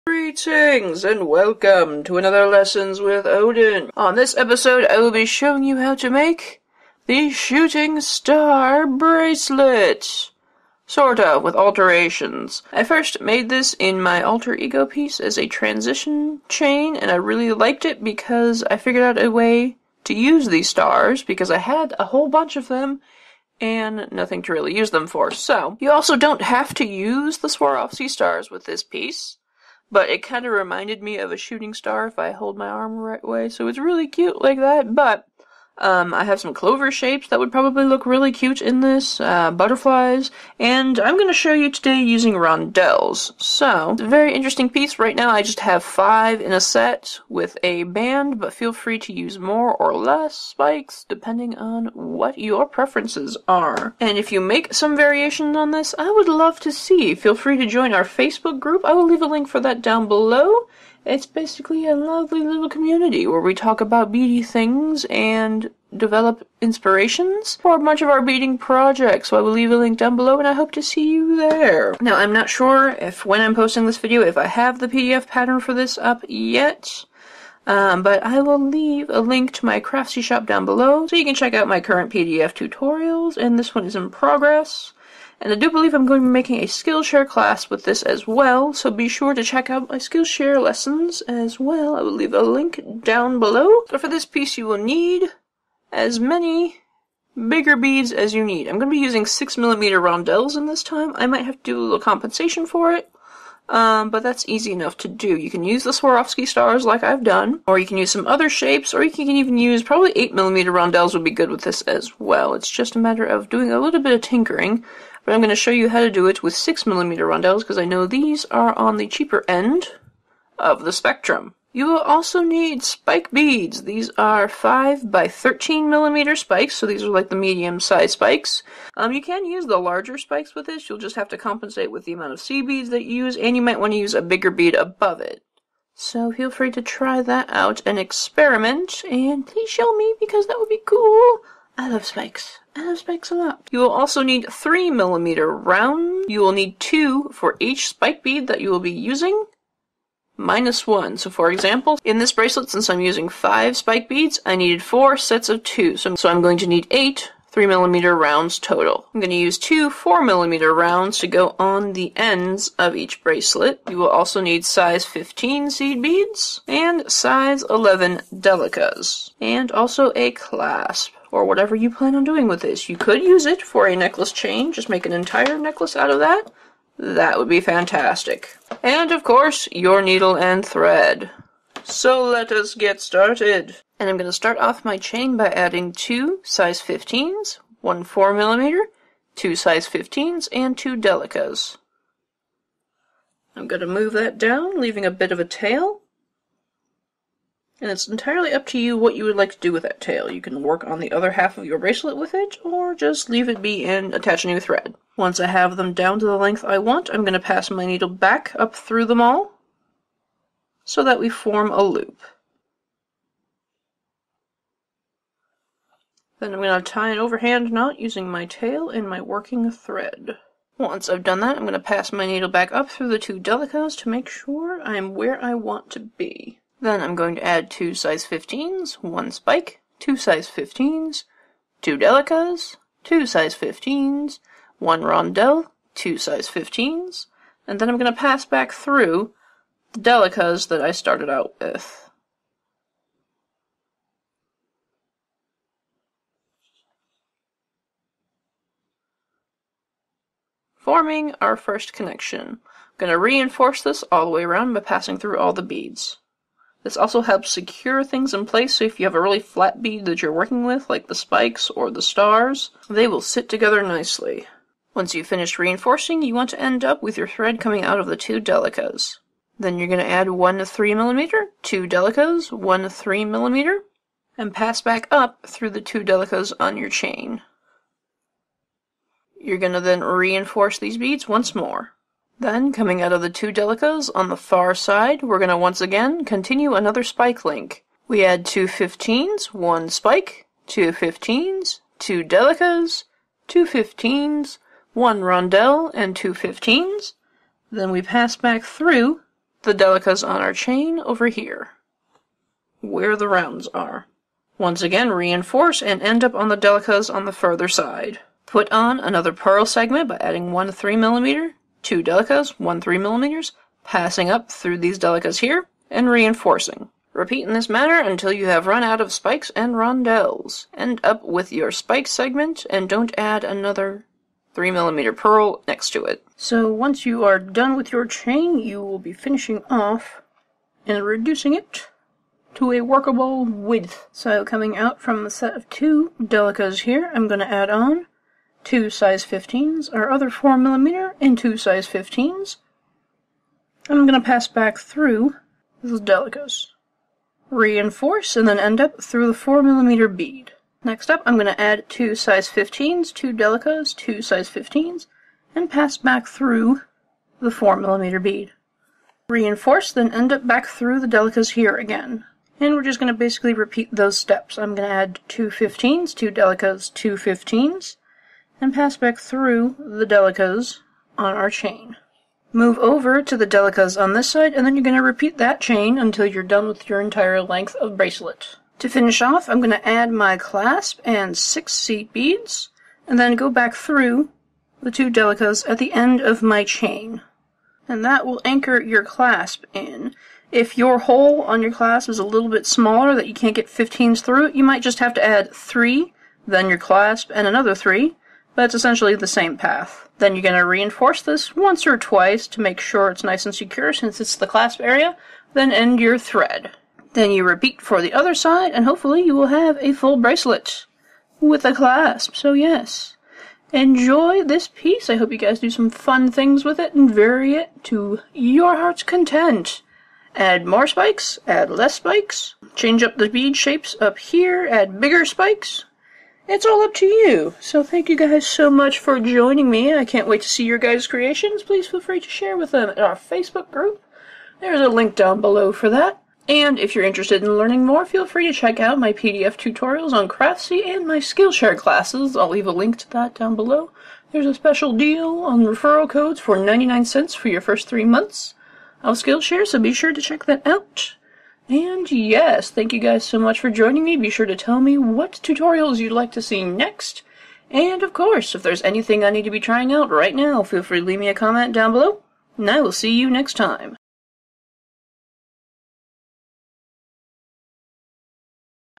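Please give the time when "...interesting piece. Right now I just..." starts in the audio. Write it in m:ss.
0:44.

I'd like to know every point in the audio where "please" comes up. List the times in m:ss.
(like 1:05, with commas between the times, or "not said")
2:19, 7:11.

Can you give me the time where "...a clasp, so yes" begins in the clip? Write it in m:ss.
6:51.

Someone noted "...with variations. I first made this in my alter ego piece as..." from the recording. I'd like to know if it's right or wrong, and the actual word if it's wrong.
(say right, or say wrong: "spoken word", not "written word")
wrong: "alterations", not "variations".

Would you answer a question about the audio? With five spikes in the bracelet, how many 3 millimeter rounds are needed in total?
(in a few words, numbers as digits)
8.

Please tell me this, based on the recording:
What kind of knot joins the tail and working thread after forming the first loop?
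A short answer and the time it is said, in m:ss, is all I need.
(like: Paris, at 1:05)
Overhand knot, at 3:37.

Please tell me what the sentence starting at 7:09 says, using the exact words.
I can't wait to see your guys' creations.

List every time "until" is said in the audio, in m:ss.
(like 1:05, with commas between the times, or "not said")
5:17, 6:15.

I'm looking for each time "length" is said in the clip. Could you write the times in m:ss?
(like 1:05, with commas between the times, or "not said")
3:26, 6:17.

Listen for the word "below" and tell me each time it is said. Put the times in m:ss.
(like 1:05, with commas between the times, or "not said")
1:00, 1:10, 1:20, 1:33, 7:15, 7:23, 7:41.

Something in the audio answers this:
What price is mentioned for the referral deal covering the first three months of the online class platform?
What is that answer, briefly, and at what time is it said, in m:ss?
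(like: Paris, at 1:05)
99 cents, at 7:26.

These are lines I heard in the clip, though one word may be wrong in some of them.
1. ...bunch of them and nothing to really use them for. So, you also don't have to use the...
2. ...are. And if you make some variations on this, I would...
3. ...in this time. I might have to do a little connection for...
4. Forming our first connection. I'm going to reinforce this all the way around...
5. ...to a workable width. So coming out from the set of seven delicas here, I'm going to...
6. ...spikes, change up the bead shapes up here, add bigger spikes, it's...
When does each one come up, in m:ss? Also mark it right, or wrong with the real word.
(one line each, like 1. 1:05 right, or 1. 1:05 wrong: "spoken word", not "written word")
1. 0:22 right
2. 0:53 right
3. 1:40 wrong: "compensation", not "connection"
4. 4:10 right
5. 5:32 wrong: "two", not "seven"
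6. 7:01 right.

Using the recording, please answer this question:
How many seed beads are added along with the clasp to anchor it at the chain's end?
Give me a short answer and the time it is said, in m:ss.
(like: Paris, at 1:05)
6, at 6:21.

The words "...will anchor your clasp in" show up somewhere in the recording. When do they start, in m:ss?
6:28.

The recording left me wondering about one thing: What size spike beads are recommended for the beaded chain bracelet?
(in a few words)
5 by 13 millimeter.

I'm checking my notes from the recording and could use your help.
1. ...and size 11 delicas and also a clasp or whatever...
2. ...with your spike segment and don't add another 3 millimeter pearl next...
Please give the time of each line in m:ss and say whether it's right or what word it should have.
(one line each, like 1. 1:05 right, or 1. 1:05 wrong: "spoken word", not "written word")
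1. 2:46 right
2. 5:21 right.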